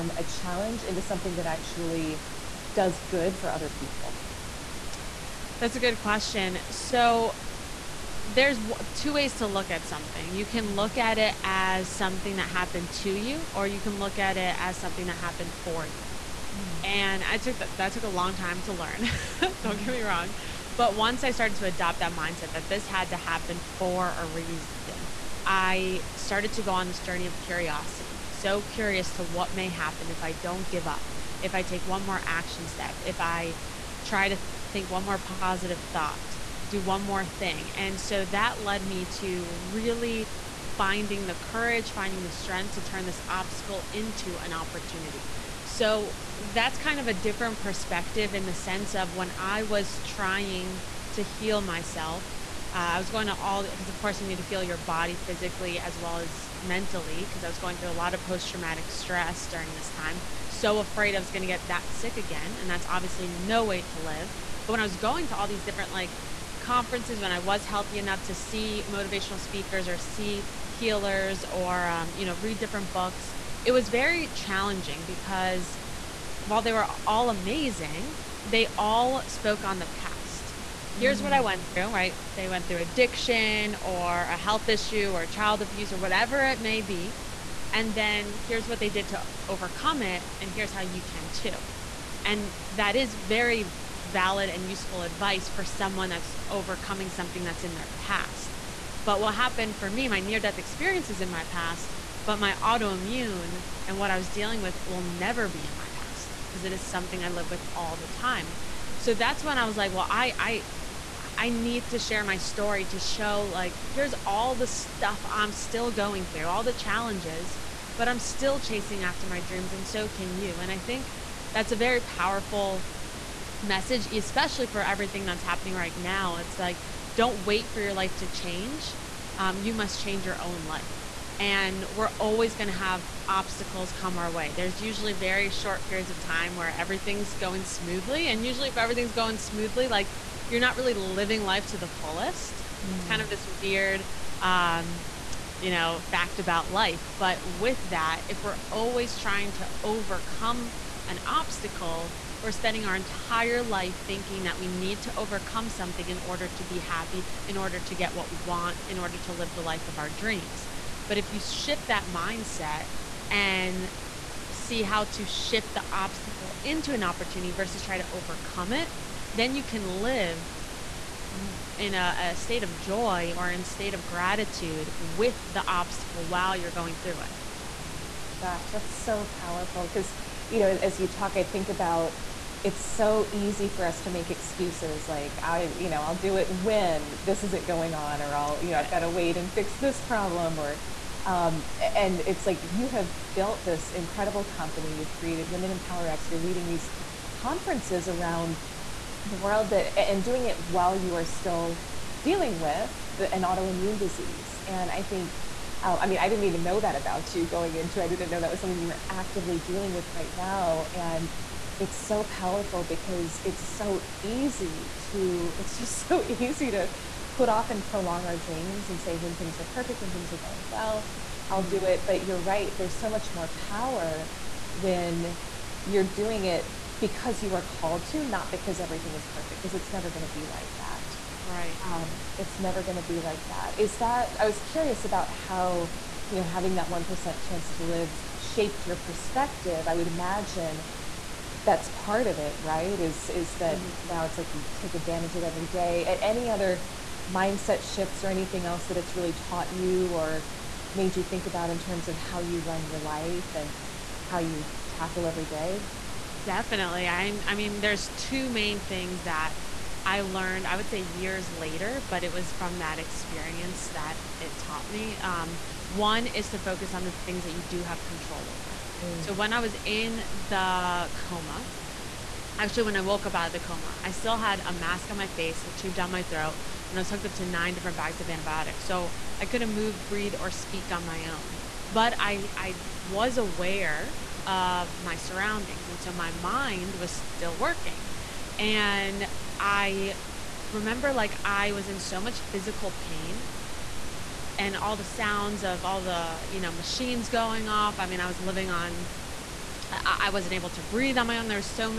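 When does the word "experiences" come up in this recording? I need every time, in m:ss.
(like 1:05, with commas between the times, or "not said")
1:40, 4:22.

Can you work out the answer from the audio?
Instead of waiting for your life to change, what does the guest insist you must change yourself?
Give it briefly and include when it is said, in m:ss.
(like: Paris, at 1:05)
Your own life, at 2:10.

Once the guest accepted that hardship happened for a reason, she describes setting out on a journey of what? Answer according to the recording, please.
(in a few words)
Curiosity.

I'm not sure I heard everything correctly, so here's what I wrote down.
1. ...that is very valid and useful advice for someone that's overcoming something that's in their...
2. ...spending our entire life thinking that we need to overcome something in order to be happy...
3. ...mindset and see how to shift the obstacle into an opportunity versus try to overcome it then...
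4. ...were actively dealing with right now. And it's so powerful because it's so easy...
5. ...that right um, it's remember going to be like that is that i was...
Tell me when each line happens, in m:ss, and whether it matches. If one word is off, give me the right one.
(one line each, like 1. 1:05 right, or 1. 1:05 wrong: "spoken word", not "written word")
1. 1:32 right
2. 2:32 right
3. 2:42 right
4. 3:28 right
5. 3:50 wrong: "never", not "remember".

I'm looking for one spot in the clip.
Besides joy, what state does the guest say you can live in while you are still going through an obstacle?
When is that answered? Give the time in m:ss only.
2:54.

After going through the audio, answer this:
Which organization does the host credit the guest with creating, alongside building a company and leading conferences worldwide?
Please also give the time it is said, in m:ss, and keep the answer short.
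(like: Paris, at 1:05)
Women Empower X, at 3:15.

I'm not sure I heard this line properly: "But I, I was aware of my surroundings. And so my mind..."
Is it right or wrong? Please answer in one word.
right.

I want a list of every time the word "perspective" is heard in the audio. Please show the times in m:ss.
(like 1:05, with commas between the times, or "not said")
0:47, 3:59.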